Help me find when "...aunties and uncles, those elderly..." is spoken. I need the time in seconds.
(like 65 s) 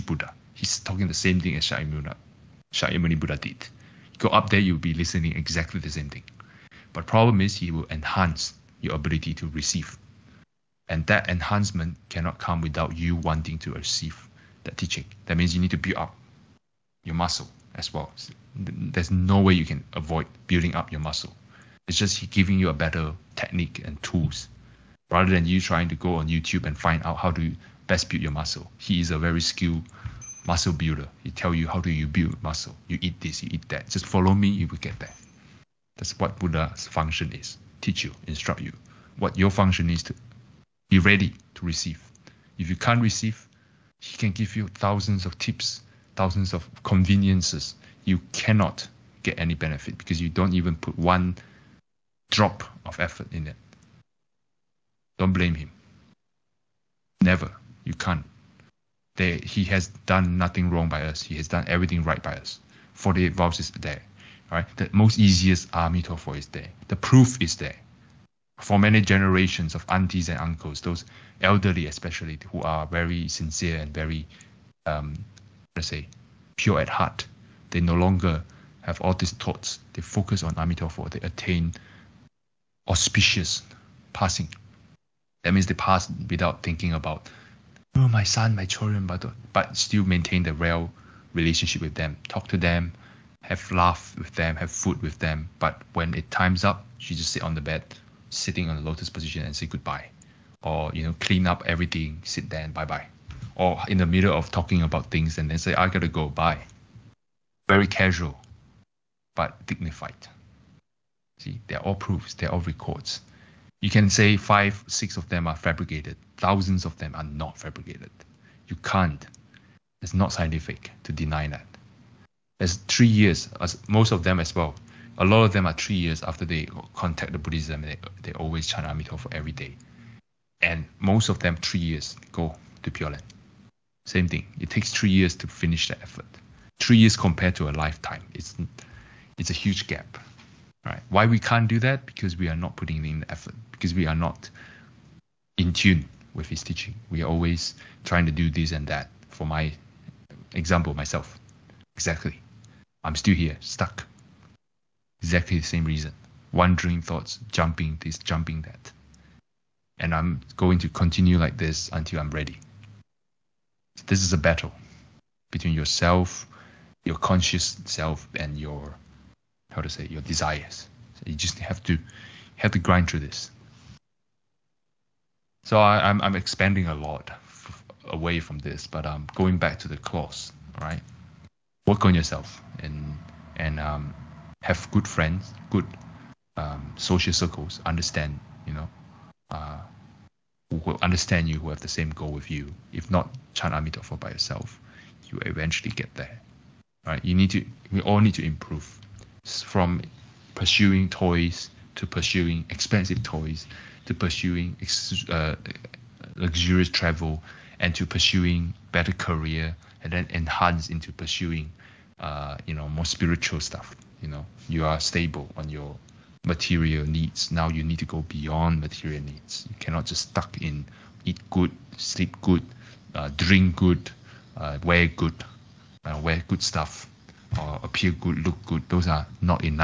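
69 s.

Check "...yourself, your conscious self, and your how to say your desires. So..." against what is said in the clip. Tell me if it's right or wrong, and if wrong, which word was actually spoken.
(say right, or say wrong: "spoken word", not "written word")
right.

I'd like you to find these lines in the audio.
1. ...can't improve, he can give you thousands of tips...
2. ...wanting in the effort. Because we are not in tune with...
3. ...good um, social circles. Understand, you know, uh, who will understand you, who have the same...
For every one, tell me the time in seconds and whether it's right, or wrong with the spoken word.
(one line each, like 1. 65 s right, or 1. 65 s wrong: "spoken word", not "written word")
1. 42 s wrong: "receive", not "improve"
2. 142 s wrong: "putting", not "wanting"
3. 185 s right.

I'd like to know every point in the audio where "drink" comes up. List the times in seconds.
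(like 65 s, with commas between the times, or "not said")
223 s.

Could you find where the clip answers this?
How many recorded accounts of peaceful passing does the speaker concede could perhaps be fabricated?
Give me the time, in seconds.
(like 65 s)
114 s.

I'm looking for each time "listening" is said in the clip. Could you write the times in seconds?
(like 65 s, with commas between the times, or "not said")
4 s.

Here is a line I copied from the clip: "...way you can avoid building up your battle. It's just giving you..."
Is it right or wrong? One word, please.
wrong.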